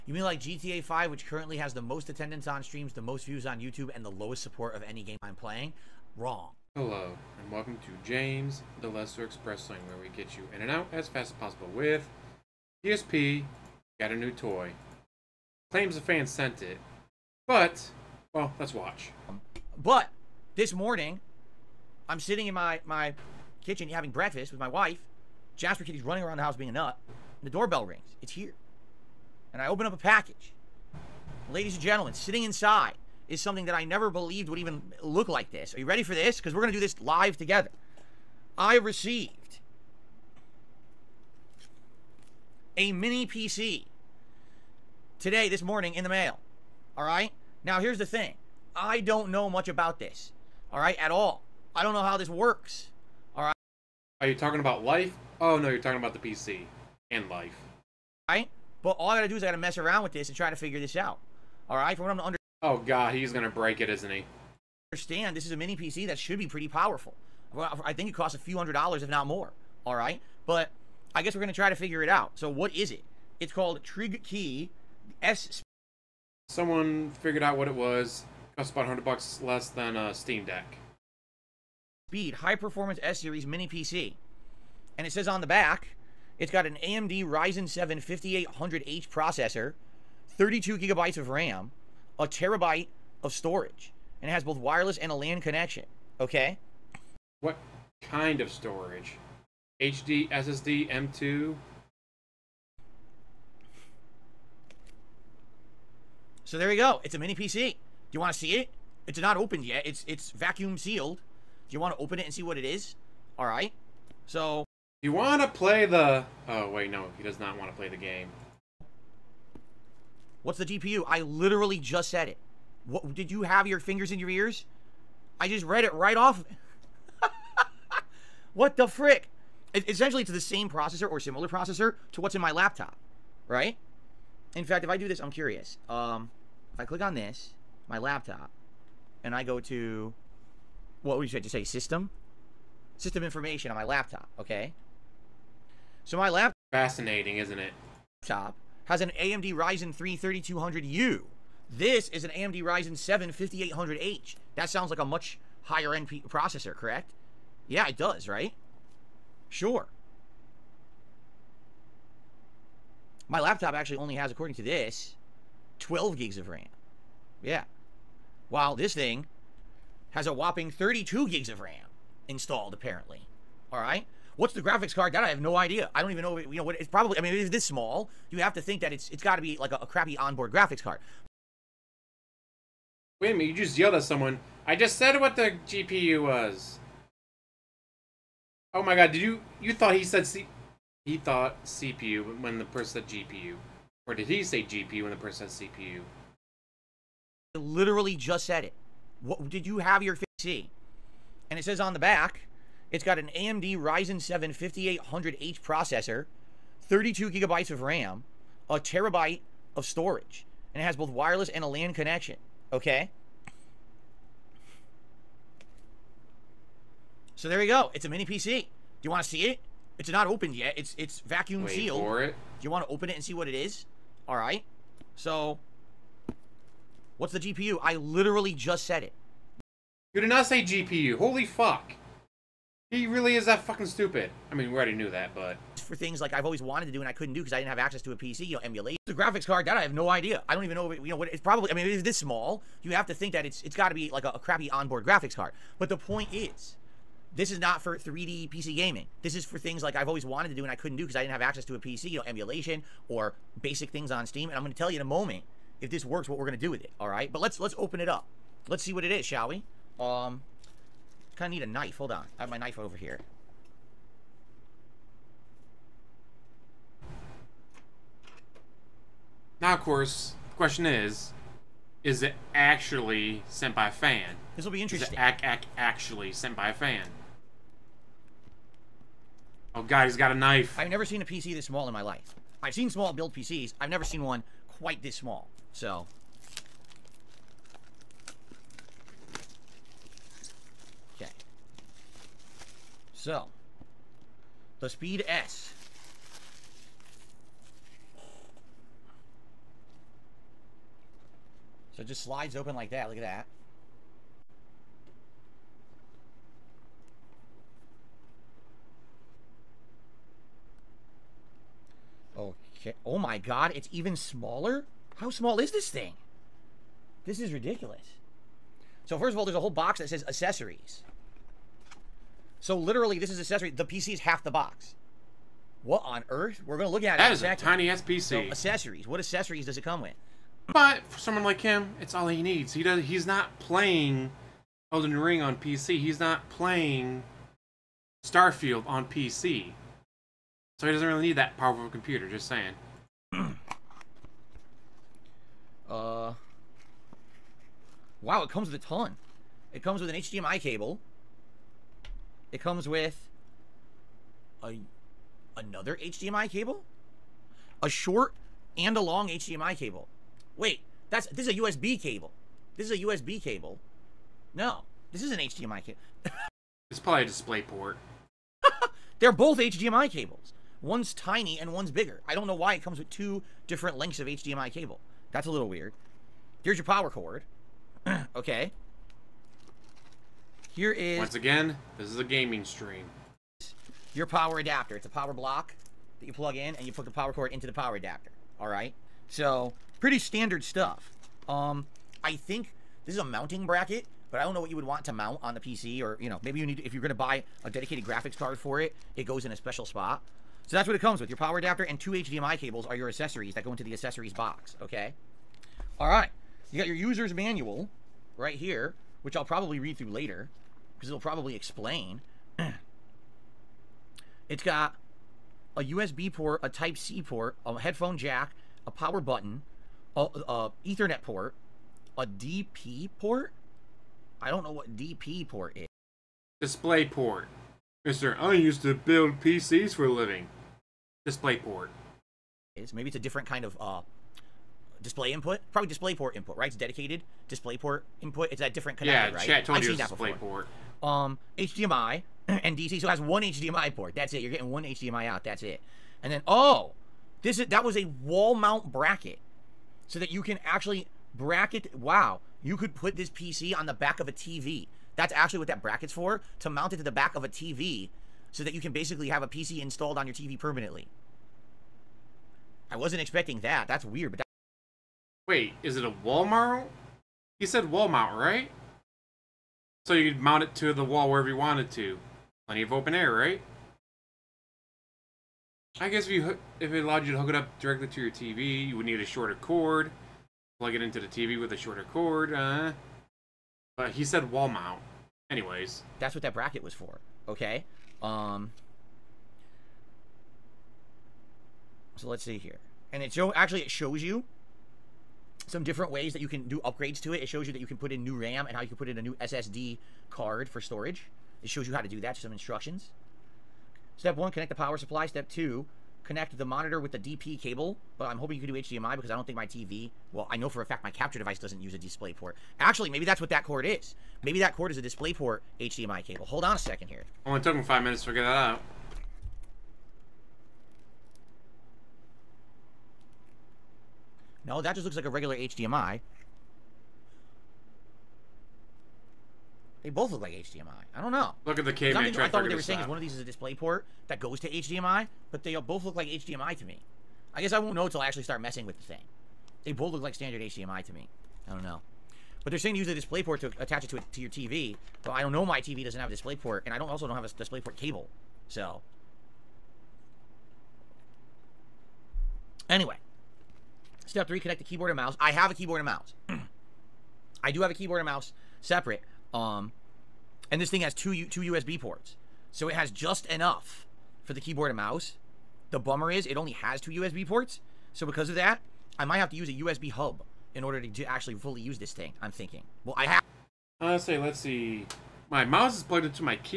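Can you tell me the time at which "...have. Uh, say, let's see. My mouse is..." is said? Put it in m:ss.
9:33.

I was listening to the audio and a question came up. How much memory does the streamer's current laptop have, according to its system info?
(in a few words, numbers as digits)
12 gigs.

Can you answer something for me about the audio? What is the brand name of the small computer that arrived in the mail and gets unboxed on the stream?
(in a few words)
Trigkey.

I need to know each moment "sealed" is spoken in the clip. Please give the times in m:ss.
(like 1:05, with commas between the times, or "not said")
1:50, 3:41.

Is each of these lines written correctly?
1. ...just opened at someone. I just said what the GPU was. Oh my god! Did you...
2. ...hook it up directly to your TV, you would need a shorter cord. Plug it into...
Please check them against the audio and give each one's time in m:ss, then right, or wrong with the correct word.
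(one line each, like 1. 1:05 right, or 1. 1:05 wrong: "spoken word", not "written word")
1. 3:03 wrong: "yelled", not "opened"
2. 7:57 right.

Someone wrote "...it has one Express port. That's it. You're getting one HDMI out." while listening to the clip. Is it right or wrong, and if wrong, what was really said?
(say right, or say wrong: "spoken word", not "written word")
wrong: "HDMI", not "Express".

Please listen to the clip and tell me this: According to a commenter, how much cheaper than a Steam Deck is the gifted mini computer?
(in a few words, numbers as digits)
about 100 bucks.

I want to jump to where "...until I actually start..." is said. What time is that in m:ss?
8:58.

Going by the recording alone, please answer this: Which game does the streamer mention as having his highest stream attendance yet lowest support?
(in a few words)
GTA 5.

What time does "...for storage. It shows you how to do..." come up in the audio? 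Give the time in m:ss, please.
8:20.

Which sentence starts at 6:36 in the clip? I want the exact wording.
To, if you're going to buy a dedicated graphics card for it, it goes in a special spot.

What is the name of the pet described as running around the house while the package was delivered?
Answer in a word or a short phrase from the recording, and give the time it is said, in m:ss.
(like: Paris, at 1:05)
Jasper, at 0:25.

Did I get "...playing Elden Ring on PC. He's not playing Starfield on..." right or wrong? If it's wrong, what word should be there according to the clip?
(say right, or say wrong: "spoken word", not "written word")
right.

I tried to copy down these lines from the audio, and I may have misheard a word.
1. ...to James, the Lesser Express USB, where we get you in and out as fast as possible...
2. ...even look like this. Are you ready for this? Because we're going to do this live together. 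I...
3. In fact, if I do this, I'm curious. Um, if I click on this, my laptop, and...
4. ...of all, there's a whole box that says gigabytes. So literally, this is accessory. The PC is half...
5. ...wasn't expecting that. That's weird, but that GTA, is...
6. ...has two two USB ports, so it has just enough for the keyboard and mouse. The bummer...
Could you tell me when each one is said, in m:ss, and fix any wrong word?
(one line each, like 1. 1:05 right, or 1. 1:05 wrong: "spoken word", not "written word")
1. 0:07 wrong: "Lane", not "USB"
2. 0:34 right
3. 2:14 right
4. 5:19 wrong: "accessories", not "gigabytes"
5. 7:42 wrong: "Wait", not "GTA"
6. 9:21 right.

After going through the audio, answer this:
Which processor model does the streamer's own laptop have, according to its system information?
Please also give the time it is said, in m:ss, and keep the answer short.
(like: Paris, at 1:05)
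AMD Ryzen 3 3200U, at 2:29.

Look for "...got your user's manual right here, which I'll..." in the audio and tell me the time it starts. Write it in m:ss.
6:46.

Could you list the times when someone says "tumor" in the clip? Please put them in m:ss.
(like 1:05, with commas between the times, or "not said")
not said.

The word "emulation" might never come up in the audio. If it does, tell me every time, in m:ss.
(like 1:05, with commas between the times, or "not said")
3:58, 4:12.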